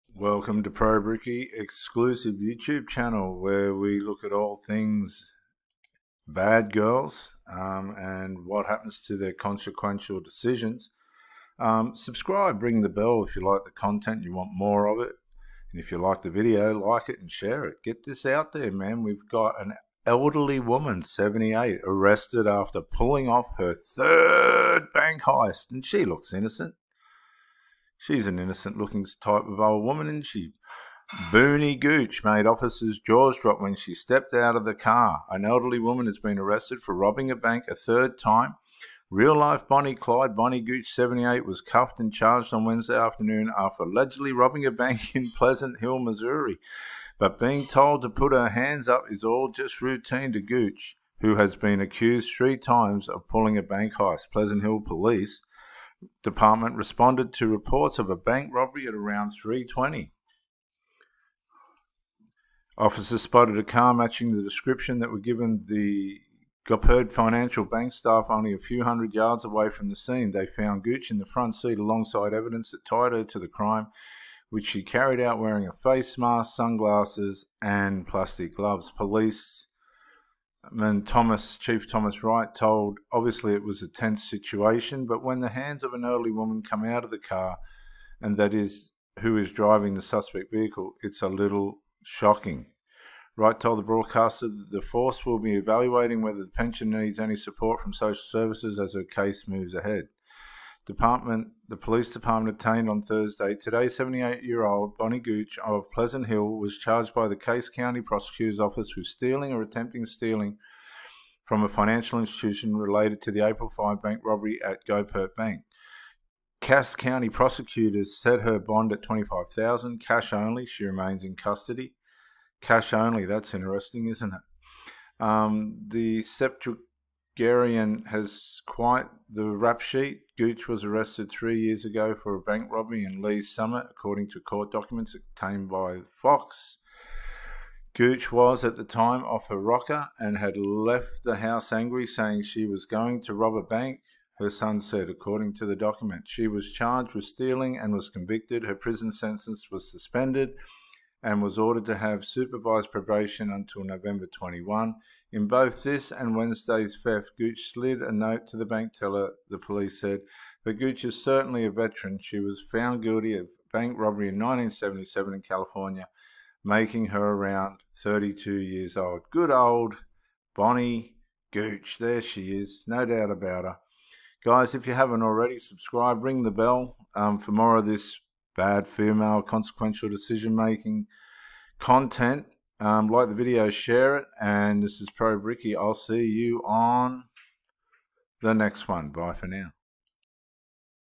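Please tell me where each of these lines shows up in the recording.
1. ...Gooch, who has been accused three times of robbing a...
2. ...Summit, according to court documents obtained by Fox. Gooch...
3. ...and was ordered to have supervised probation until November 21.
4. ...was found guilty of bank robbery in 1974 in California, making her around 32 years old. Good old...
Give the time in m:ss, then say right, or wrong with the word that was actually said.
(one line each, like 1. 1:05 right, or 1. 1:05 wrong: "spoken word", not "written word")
1. 0:50 wrong: "pulling", not "robbing"
2. 2:13 right
3. 2:31 right
4. 2:42 wrong: "1977", not "1974".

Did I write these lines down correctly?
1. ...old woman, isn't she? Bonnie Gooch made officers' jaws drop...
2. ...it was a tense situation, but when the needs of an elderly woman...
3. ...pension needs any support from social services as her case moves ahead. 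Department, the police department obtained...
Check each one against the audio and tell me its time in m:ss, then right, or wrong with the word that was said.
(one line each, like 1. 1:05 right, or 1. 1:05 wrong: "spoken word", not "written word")
1. 0:29 right
2. 1:23 wrong: "hands", not "needs"
3. 1:36 right.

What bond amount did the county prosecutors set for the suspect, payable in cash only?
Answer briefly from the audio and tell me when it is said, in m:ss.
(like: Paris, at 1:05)
25,000, at 1:59.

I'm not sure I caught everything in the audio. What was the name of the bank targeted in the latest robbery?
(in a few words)
Goppert Financial Bank.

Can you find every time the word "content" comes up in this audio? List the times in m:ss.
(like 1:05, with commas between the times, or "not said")
0:13, 3:01.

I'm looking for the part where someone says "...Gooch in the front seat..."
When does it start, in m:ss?
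1:10.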